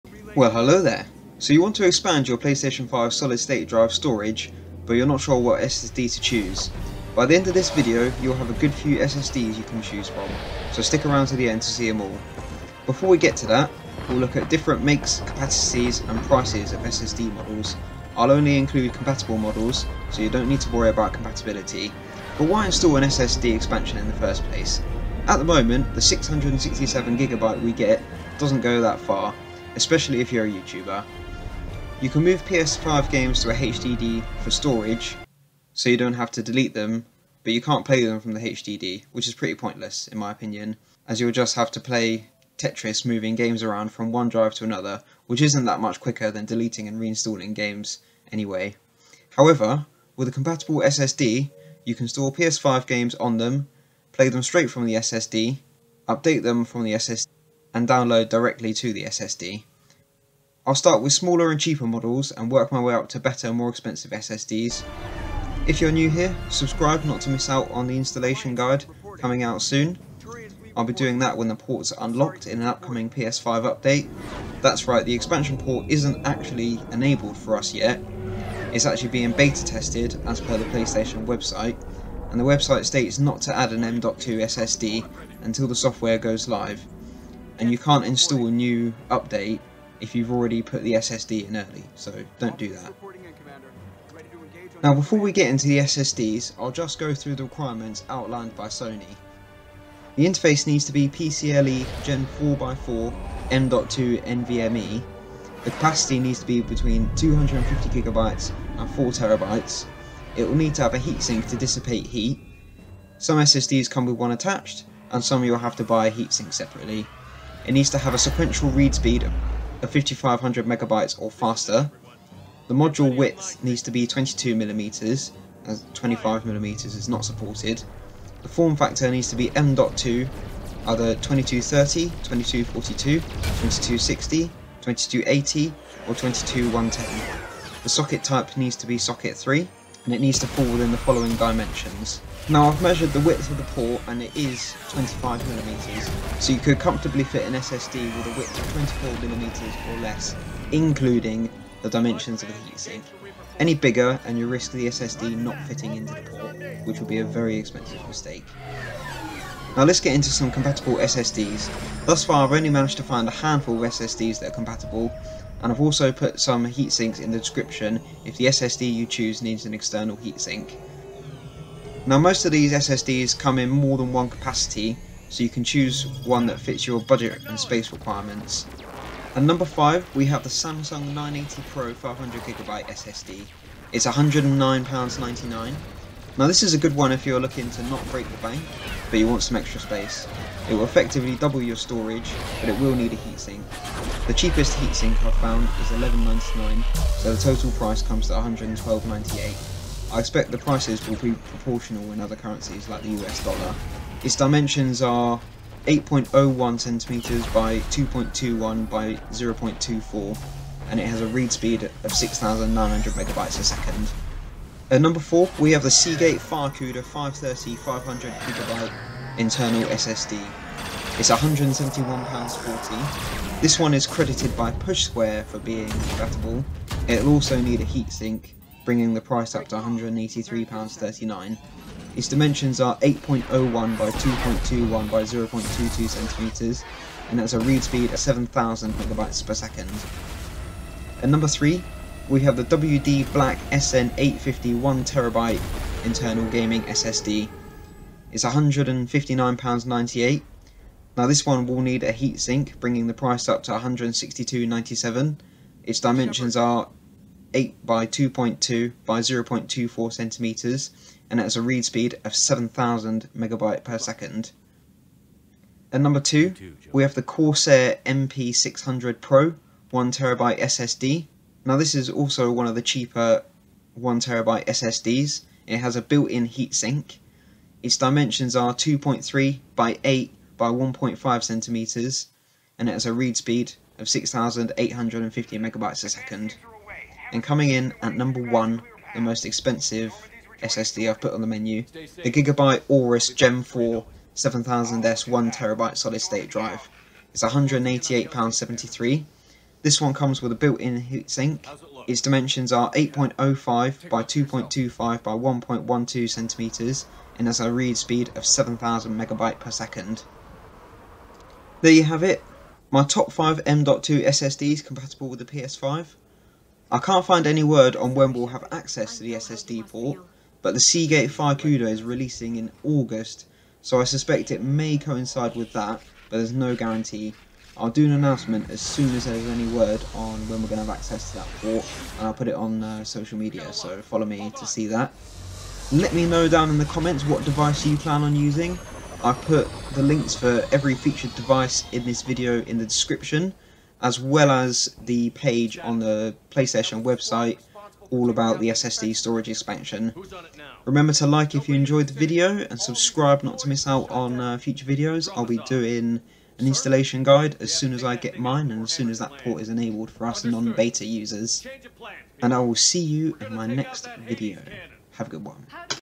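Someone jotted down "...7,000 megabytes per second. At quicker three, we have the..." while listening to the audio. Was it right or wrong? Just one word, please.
wrong.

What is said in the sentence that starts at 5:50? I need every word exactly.
Remember to like if you enjoyed the video and subscribe not to miss out on uh, future videos.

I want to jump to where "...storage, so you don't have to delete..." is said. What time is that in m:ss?
0:34.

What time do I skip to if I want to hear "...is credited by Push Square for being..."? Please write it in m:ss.
3:43.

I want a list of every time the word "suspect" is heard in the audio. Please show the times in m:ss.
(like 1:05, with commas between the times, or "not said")
5:24.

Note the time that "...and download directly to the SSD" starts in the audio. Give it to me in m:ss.
0:57.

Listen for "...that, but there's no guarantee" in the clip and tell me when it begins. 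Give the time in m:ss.
5:25.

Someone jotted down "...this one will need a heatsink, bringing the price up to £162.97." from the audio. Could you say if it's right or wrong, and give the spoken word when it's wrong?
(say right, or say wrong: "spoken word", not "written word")
right.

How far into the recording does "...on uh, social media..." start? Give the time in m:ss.
5:32.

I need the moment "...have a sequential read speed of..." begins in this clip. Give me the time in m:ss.
1:57.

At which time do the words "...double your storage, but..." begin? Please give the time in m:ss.
3:11.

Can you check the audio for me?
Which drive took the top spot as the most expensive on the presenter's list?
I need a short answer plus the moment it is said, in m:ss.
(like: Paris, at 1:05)
Gigabyte Aorus Gen 4 7000S, at 4:52.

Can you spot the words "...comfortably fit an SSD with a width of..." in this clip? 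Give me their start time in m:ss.
2:26.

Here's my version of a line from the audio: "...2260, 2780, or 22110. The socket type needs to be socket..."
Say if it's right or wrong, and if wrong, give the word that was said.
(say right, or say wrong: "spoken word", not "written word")
wrong: "2280", not "2780".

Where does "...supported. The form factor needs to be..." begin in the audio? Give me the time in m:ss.
2:07.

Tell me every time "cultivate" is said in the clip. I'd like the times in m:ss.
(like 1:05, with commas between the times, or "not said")
not said.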